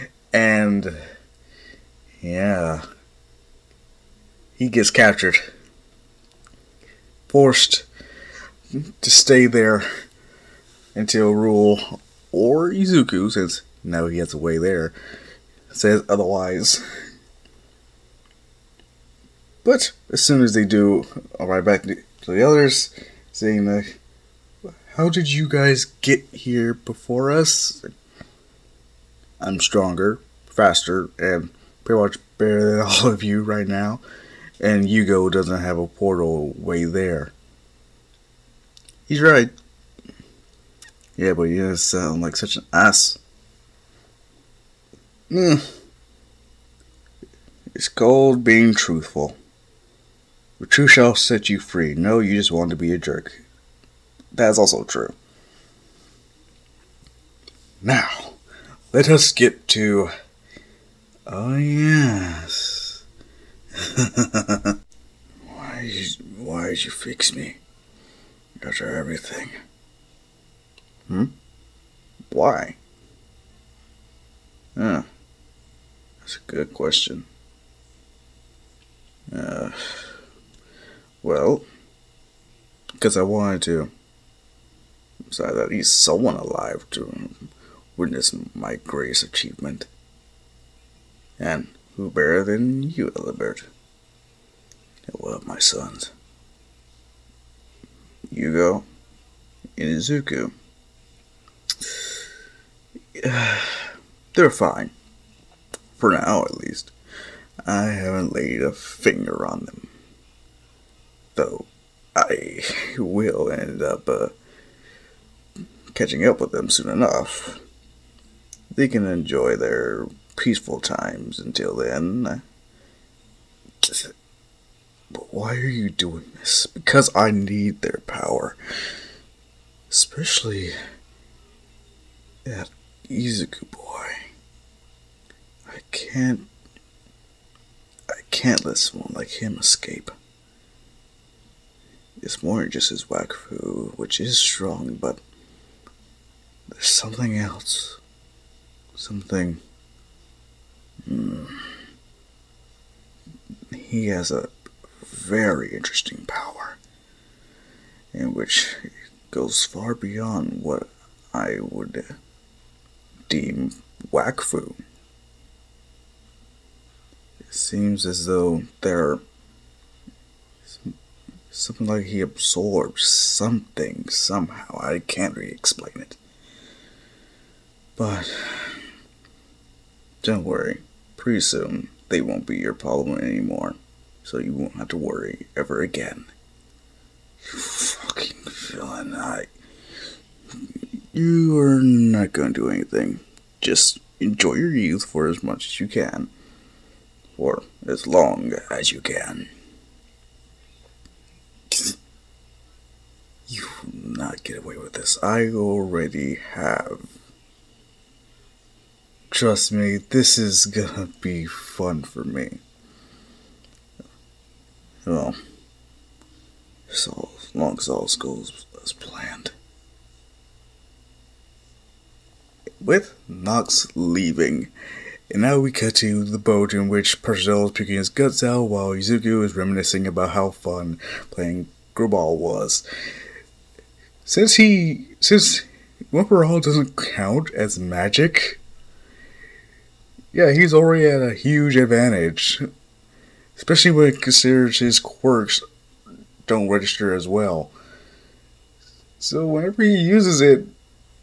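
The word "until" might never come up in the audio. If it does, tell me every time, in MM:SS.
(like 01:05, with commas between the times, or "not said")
00:10, 02:01.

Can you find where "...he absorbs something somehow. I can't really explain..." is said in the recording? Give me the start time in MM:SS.
02:52.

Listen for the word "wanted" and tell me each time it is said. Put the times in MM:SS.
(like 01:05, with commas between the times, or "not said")
00:52, 01:23.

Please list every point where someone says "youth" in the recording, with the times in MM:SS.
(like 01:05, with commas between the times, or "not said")
03:14.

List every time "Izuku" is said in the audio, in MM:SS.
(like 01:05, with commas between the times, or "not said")
00:12, 02:13.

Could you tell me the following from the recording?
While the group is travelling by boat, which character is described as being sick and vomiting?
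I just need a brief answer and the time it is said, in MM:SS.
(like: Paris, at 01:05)
Parcel, at 03:47.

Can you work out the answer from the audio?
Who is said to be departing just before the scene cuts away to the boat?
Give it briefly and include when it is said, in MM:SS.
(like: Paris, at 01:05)
Nox, at 03:43.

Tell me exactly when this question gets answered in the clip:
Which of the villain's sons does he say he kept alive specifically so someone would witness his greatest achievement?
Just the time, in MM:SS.
01:33.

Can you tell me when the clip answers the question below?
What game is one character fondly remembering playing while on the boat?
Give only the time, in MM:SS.
03:51.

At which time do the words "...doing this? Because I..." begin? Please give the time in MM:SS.
02:05.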